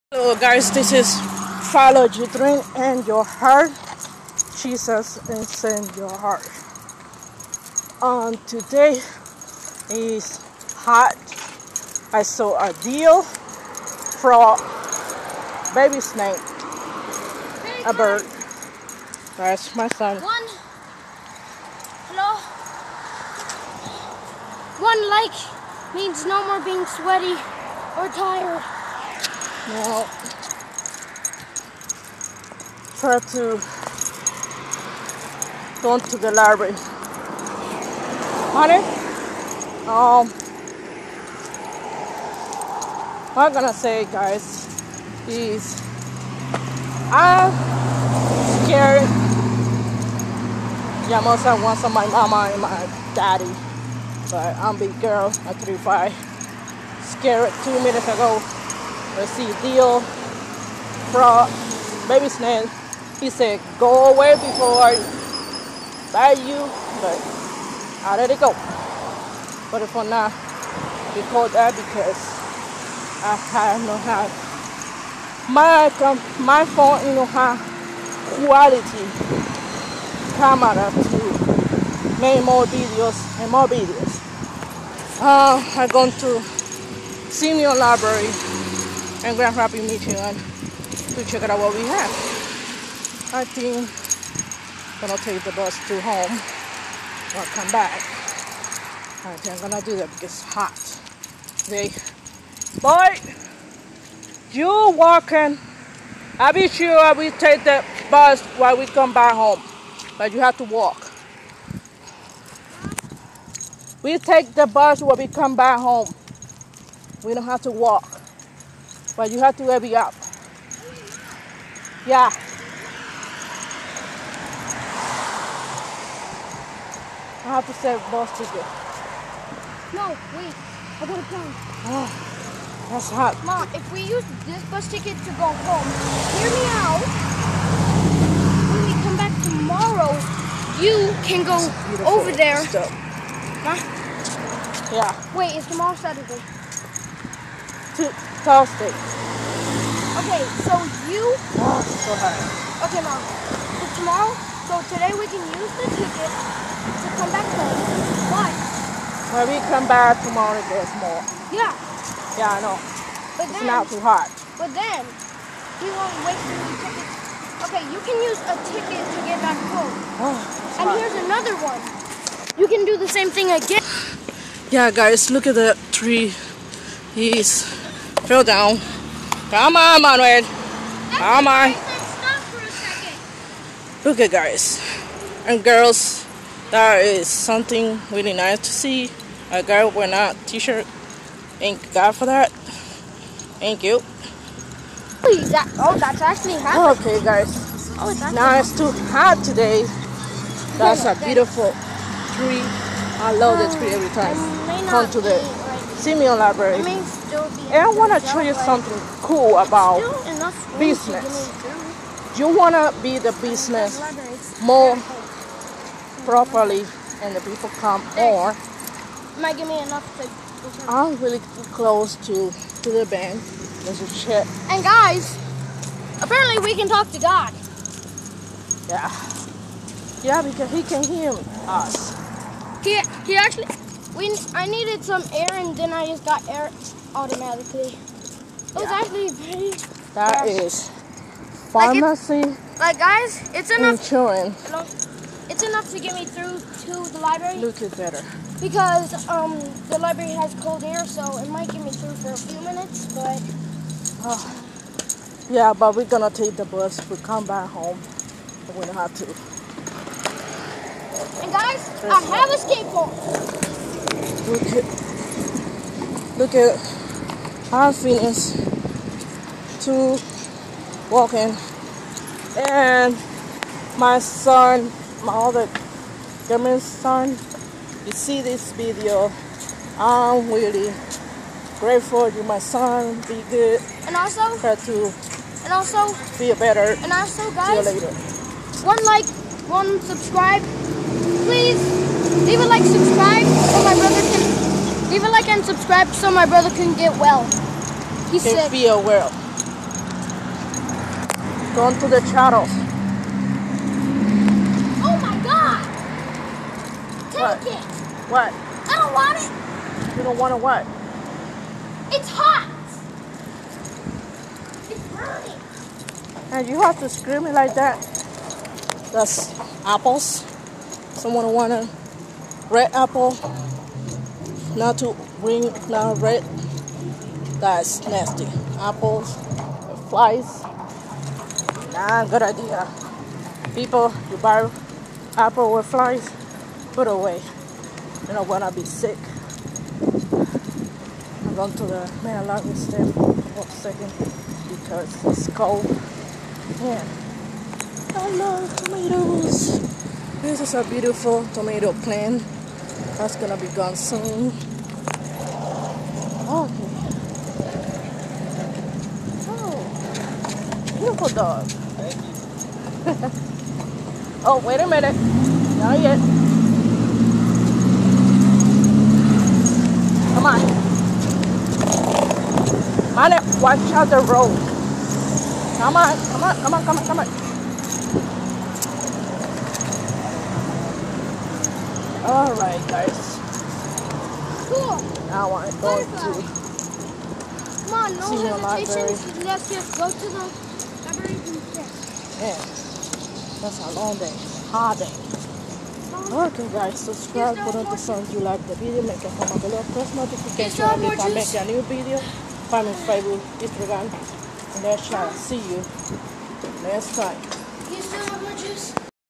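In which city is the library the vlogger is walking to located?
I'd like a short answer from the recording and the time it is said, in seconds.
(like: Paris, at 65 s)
Grand Rapids, Michigan, at 89 s.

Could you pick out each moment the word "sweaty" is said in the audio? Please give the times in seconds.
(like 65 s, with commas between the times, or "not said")
26 s.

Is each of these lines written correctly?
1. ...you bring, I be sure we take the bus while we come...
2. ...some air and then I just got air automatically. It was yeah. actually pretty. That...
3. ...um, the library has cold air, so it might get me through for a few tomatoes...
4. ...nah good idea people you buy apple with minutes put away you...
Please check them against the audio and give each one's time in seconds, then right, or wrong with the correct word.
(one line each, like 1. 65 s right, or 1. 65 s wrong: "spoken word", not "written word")
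1. 104 s wrong: "walking", not "bring"
2. 235 s right
3. 249 s wrong: "minutes", not "tomatoes"
4. 331 s wrong: "flies", not "minutes".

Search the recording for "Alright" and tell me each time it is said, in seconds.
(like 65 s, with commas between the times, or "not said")
382 s.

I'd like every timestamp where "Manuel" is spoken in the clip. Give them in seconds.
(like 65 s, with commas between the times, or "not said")
180 s.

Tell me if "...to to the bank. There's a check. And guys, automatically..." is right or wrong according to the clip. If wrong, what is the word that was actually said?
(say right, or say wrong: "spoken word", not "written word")
wrong: "apparently", not "automatically".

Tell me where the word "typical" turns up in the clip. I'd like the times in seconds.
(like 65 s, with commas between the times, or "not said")
not said.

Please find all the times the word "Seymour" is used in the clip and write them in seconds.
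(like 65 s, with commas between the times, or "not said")
87 s, 206 s.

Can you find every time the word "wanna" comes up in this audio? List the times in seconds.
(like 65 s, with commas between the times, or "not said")
321 s.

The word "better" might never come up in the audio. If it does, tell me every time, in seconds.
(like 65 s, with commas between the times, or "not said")
247 s, 286 s.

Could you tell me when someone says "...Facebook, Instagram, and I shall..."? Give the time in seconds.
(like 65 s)
402 s.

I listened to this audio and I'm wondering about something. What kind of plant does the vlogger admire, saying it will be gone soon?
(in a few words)
Tomato plant.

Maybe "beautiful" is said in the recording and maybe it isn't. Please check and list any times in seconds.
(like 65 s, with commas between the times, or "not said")
201 s, 350 s, 360 s.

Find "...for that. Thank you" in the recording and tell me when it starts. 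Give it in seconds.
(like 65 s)
192 s.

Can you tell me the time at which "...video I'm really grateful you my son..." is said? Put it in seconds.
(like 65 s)
278 s.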